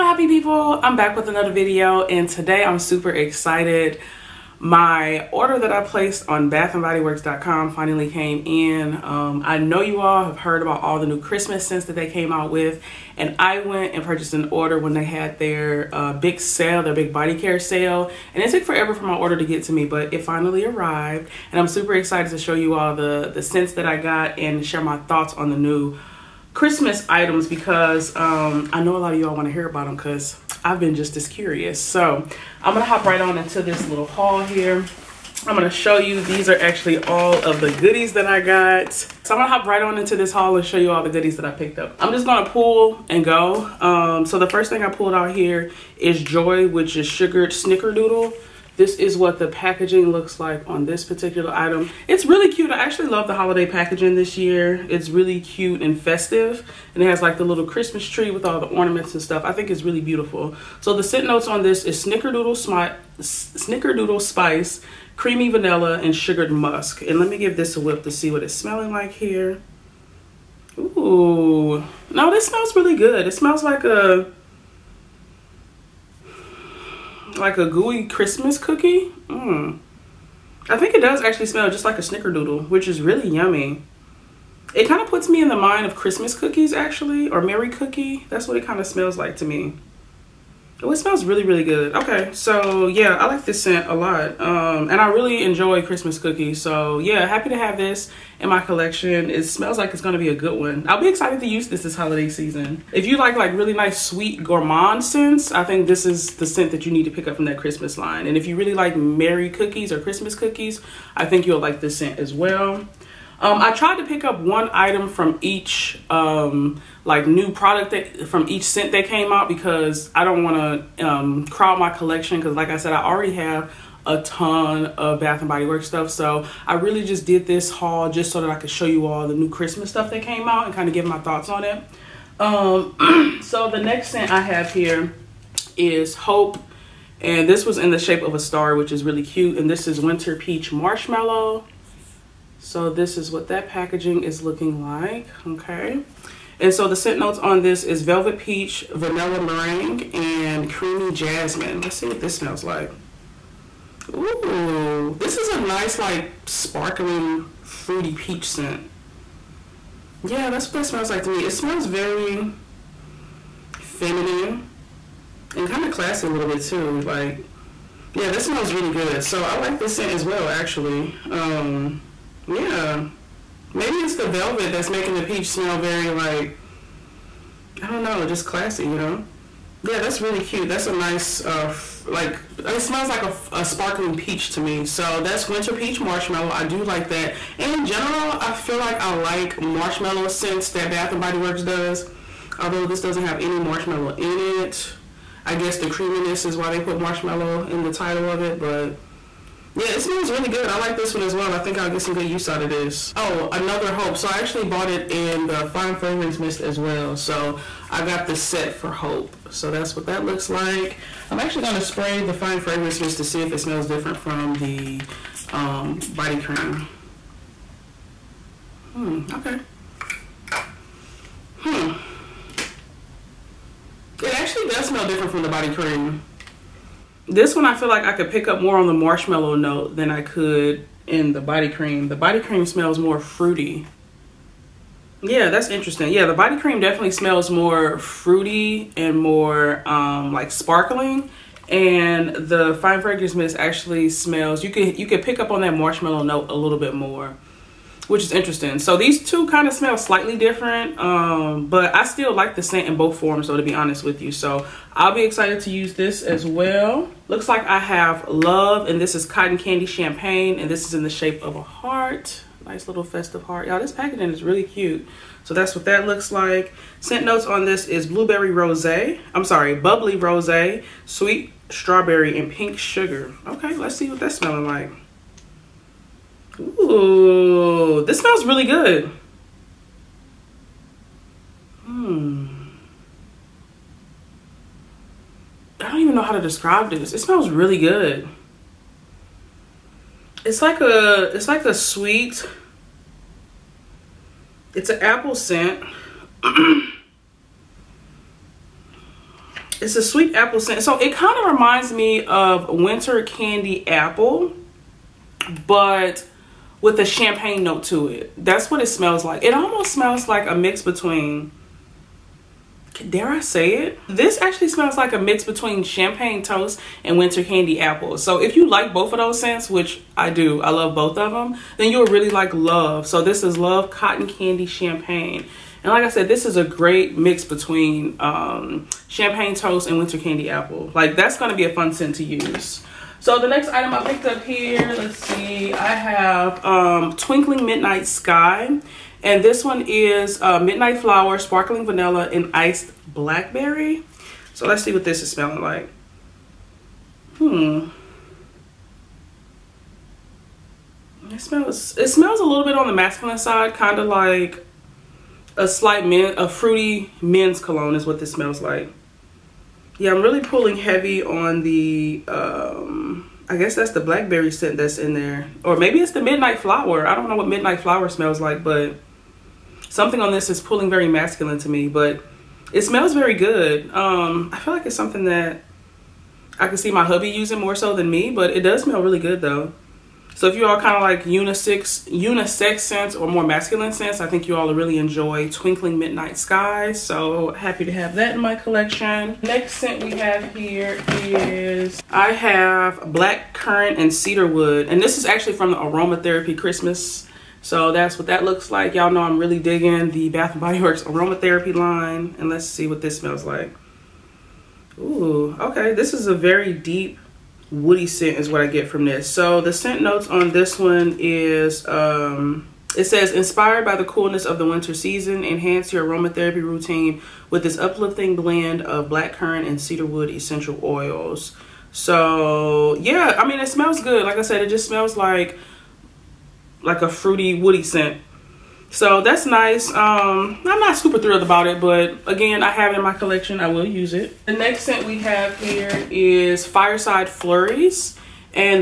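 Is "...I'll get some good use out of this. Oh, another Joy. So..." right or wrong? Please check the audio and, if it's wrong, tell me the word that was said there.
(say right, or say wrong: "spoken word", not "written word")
wrong: "Hope", not "Joy".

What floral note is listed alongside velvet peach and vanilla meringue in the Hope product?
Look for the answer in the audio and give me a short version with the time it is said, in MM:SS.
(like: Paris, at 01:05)
Creamy Jasmine, at 02:30.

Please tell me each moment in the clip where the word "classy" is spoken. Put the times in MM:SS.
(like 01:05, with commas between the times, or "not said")
02:45, 02:58.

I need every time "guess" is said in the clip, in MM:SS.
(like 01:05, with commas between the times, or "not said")
03:15, 06:03.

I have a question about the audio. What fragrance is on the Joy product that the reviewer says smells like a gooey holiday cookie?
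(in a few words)
Sugared Snickerdoodle.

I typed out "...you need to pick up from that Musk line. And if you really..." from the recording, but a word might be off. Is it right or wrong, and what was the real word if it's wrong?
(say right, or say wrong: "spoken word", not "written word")
wrong: "Christmas", not "Musk".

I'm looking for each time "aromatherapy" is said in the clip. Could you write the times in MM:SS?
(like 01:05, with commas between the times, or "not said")
06:35, 06:41, 06:56.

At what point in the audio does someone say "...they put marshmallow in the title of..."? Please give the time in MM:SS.
03:16.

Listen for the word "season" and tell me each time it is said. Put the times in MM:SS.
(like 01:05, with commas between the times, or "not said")
01:42, 06:54.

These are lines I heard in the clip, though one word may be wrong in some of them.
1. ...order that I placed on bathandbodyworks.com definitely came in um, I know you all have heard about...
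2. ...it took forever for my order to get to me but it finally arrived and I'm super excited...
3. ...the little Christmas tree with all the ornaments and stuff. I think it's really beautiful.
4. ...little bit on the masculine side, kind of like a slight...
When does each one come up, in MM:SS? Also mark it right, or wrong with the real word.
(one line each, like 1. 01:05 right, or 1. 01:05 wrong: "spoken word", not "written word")
1. 00:05 wrong: "finally", not "definitely"
2. 00:18 right
3. 00:57 right
4. 05:52 right.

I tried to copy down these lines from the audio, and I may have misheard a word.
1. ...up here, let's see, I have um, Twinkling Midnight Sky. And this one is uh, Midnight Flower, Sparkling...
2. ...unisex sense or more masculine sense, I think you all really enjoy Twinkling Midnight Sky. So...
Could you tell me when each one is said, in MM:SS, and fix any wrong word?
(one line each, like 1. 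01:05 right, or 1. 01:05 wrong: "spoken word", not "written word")
1. 05:34 right
2. 06:22 right.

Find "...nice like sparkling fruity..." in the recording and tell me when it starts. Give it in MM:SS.
02:35.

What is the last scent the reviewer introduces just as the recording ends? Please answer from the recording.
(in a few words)
Fireside Flurries.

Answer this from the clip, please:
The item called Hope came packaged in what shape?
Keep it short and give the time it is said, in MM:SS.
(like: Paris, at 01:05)
A star, at 02:17.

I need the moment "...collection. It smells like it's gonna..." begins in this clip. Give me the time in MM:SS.
01:38.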